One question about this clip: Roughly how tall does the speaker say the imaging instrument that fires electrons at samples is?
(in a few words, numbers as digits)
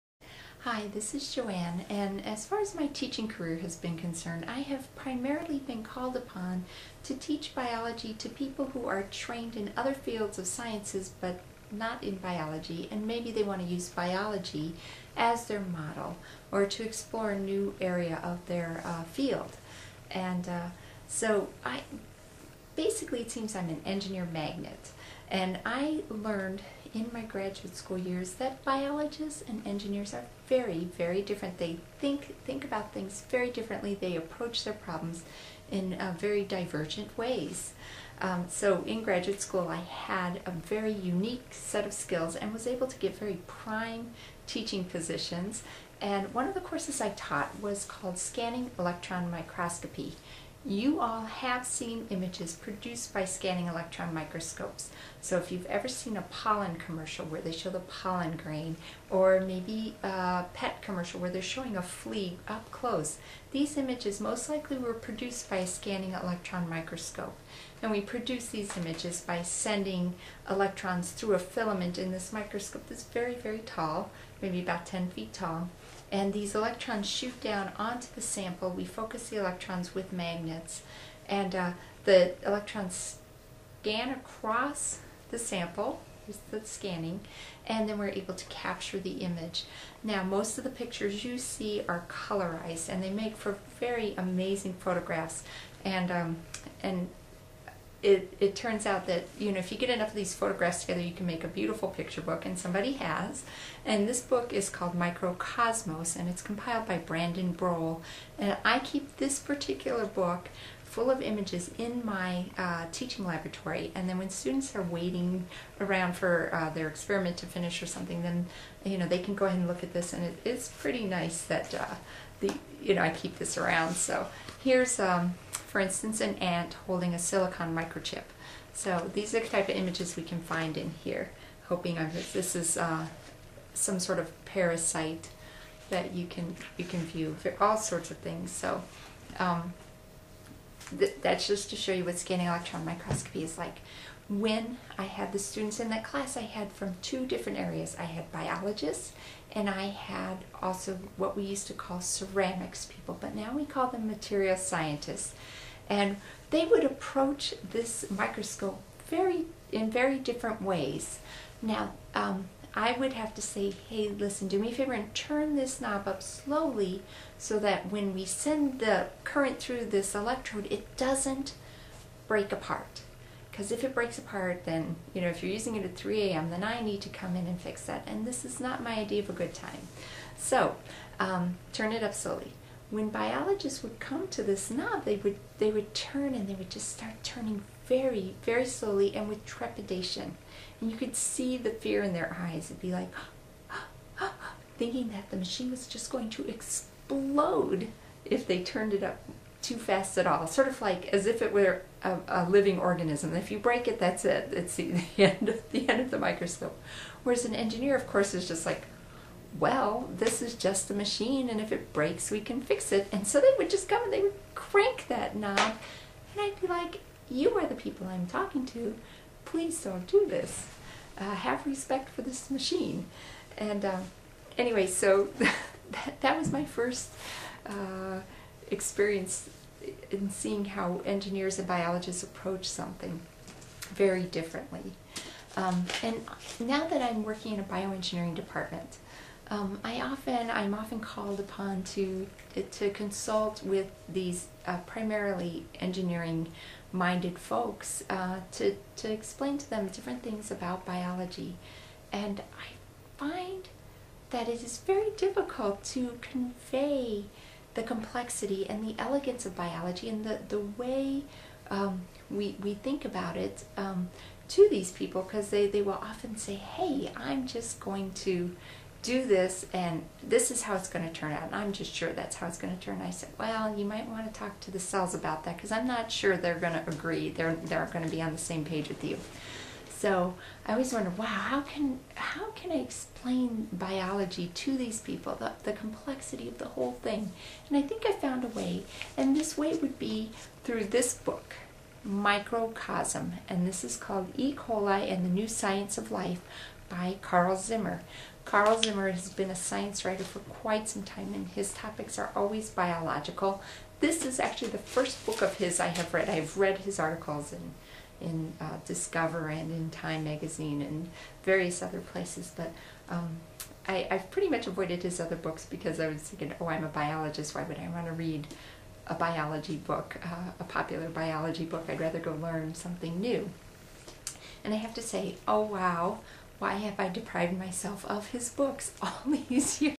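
about 10 feet.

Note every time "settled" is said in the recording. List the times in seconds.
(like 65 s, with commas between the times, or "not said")
not said.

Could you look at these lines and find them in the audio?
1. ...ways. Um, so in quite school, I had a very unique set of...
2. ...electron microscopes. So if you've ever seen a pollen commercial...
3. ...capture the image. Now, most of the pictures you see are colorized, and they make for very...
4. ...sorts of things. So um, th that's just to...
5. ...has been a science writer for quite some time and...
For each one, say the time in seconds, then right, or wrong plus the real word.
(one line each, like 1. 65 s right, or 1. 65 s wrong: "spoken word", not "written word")
1. 37 s wrong: "graduate", not "quite"
2. 53 s right
3. 88 s right
4. 137 s right
5. 299 s right.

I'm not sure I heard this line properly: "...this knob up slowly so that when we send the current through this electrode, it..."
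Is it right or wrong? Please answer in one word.
right.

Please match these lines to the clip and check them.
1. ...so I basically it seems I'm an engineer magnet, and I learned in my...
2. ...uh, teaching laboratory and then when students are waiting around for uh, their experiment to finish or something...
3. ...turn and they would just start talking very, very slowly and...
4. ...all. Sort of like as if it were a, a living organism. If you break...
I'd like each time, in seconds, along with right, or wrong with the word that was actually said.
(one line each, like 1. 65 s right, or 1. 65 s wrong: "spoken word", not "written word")
1. 21 s right
2. 112 s right
3. 185 s wrong: "turning", not "talking"
4. 200 s right.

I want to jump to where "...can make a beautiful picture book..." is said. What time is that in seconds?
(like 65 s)
101 s.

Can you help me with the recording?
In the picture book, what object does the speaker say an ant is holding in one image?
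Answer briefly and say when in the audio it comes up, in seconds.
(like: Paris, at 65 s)
a silicon microchip, at 127 s.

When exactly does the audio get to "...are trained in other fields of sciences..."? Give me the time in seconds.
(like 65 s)
8 s.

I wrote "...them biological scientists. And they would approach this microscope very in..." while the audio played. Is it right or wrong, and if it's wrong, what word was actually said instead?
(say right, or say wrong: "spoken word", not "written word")
wrong: "material", not "biological".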